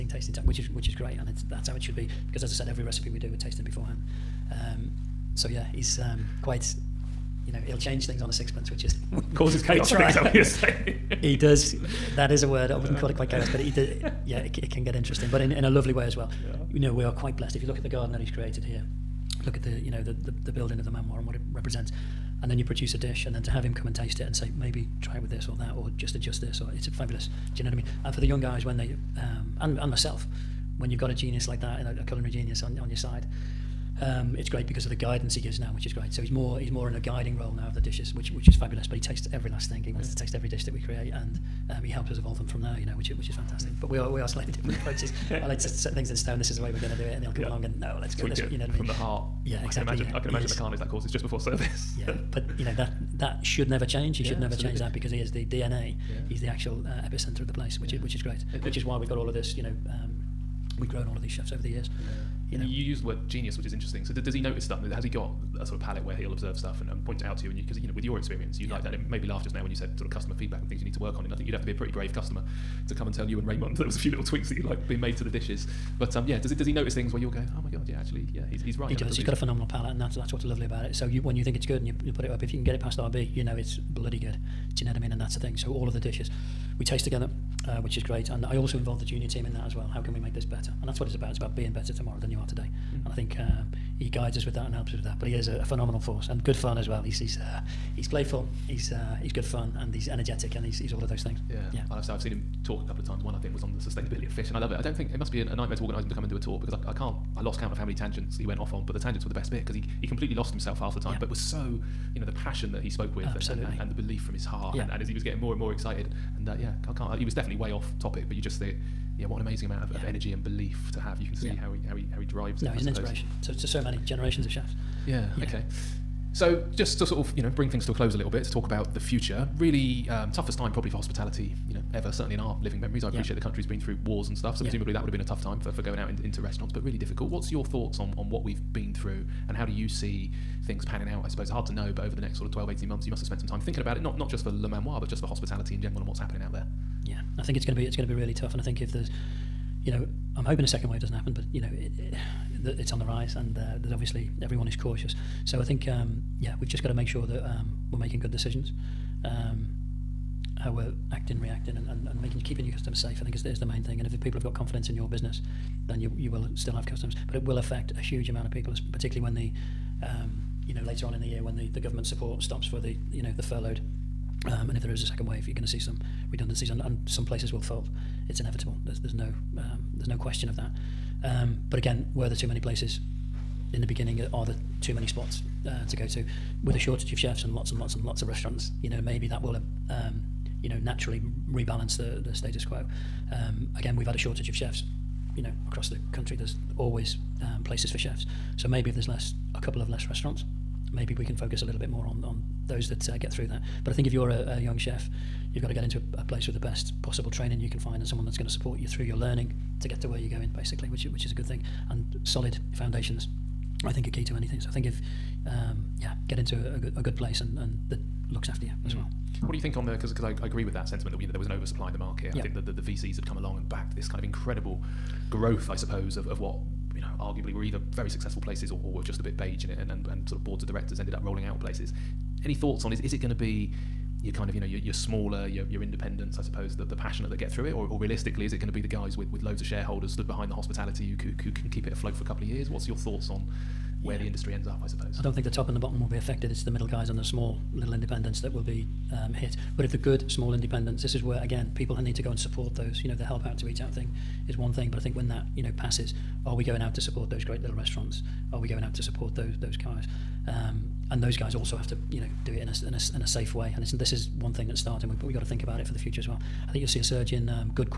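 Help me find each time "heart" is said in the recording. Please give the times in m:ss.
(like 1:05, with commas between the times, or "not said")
0:48, 1:54.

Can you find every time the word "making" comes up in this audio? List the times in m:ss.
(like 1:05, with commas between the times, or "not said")
2:37, 2:42.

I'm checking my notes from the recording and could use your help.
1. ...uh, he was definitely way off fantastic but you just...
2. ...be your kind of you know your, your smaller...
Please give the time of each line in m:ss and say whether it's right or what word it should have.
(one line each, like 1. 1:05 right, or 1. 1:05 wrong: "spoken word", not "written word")
1. 1:57 wrong: "topic", not "fantastic"
2. 3:53 right.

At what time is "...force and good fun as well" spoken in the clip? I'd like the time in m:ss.
1:35.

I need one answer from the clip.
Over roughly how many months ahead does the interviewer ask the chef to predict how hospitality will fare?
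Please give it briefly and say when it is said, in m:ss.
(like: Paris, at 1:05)
12 to 18, at 2:22.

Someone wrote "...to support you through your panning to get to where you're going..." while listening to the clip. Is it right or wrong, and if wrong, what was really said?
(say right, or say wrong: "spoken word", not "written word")
wrong: "learning", not "panning".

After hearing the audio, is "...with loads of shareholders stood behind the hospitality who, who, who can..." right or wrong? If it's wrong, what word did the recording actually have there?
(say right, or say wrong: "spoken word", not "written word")
right.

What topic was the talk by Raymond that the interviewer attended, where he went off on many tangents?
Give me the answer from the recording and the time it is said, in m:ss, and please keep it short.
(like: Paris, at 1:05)
sustainability of fish, at 1:43.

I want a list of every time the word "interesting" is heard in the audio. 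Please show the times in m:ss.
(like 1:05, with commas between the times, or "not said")
0:14, 1:03.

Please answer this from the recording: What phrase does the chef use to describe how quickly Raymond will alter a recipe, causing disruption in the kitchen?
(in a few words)
on a sixpence.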